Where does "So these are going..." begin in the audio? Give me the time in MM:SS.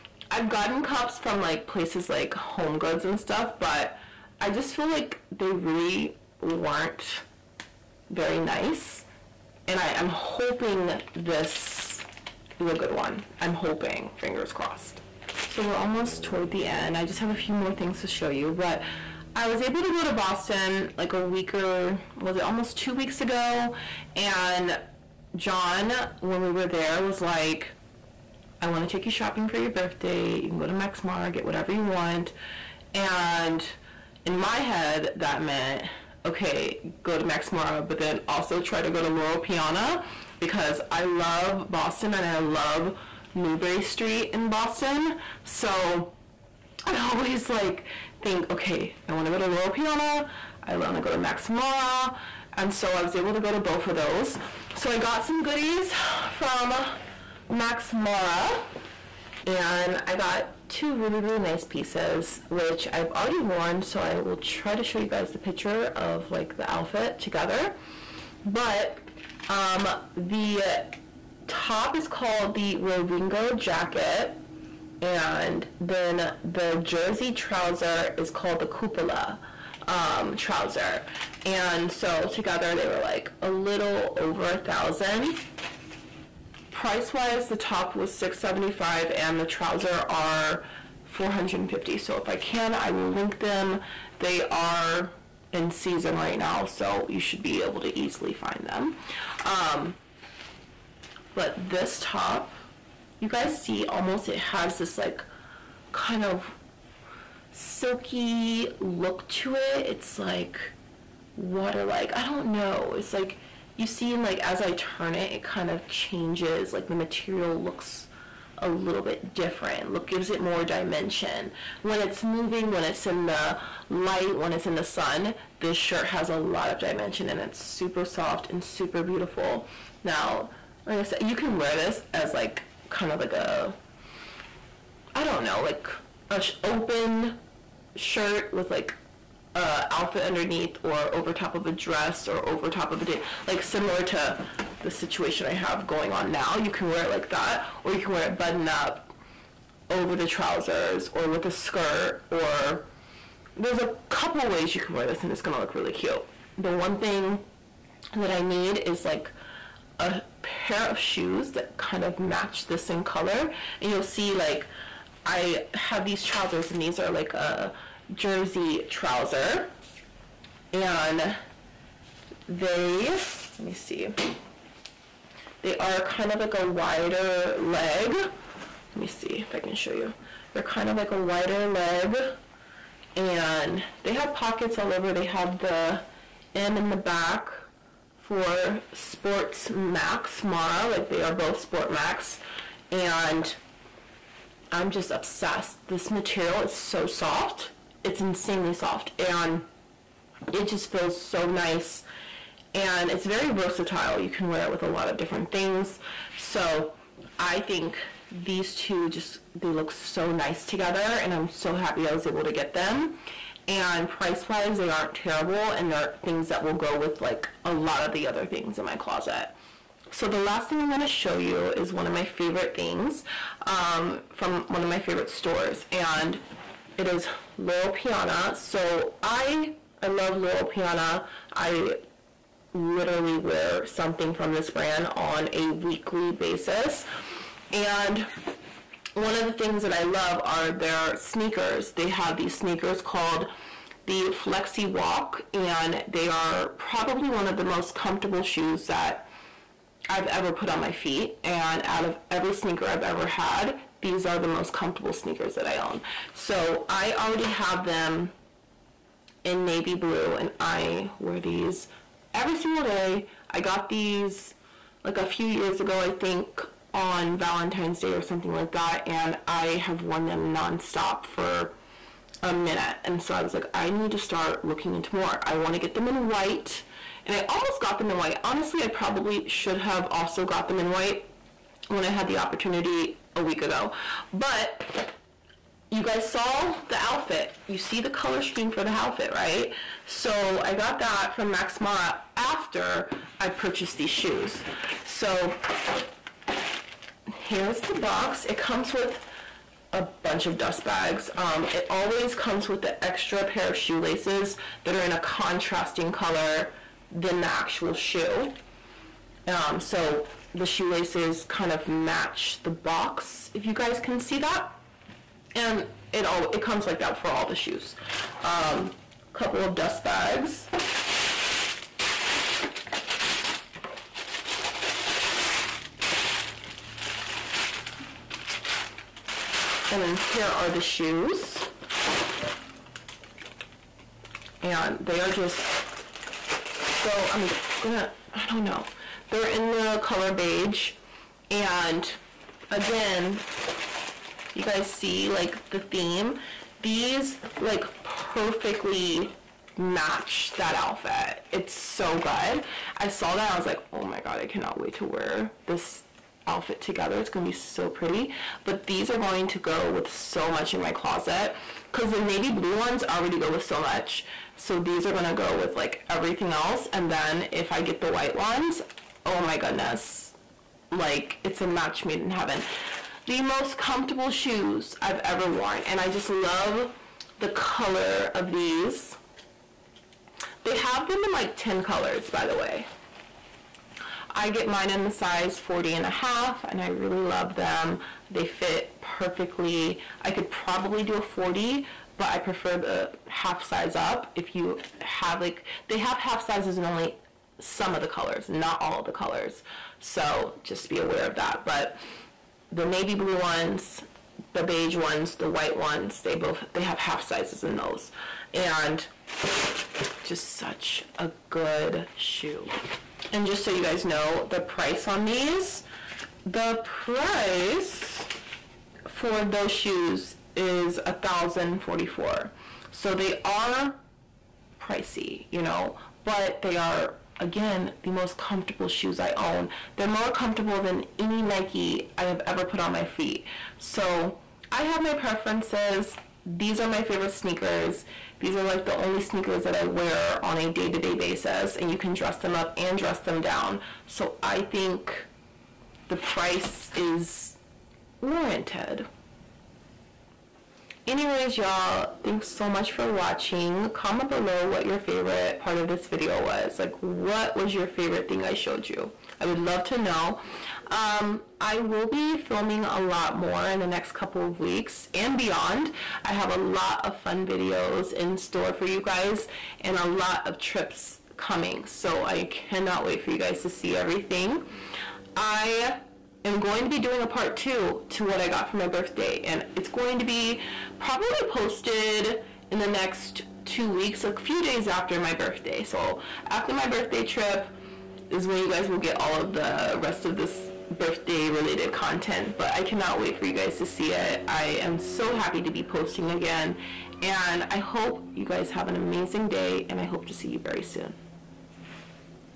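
06:04.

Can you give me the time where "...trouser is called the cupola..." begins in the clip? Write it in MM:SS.
01:17.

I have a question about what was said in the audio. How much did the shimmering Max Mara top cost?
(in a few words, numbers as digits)
675.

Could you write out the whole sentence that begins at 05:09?
Um, so the shoelaces kind of match the box, if you guys can see that.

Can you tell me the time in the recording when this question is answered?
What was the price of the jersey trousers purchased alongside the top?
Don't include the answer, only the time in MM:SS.
01:31.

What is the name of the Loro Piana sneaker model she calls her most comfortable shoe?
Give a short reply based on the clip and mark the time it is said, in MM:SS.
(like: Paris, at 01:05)
Flexy Walk, at 04:04.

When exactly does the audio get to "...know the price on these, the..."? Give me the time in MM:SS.
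06:54.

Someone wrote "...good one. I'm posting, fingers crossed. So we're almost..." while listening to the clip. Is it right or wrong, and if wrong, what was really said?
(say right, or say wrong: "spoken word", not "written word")
wrong: "hoping", not "posting".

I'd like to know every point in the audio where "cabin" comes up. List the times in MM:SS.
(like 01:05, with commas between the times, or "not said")
not said.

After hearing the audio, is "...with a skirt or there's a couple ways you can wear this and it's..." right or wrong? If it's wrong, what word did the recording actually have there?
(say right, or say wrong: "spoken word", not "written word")
right.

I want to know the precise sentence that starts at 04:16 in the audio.
So I already have them in navy blue and I wear these every single day.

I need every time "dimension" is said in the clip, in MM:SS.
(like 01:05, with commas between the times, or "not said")
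02:00, 02:06.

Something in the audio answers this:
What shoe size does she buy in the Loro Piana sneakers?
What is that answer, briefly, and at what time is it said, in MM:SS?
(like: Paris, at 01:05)
40.5, at 06:25.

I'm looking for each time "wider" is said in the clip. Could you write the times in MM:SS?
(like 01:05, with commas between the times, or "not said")
02:56, 03:01.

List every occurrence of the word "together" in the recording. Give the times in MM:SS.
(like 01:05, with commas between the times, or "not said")
01:07, 01:22, 03:30, 05:56.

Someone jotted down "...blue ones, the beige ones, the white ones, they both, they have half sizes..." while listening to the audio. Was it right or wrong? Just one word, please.
right.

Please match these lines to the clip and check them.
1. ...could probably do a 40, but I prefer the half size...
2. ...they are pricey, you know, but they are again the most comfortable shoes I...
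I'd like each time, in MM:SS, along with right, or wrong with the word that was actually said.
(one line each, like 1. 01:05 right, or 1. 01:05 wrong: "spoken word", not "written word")
1. 06:30 right
2. 07:03 right.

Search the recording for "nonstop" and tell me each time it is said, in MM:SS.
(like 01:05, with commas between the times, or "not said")
04:30.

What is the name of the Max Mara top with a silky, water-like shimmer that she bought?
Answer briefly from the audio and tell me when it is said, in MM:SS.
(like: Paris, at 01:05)
Rovingo jacket, at 01:12.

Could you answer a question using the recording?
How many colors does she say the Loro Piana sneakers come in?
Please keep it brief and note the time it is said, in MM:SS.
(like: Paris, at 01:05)
10, at 06:21.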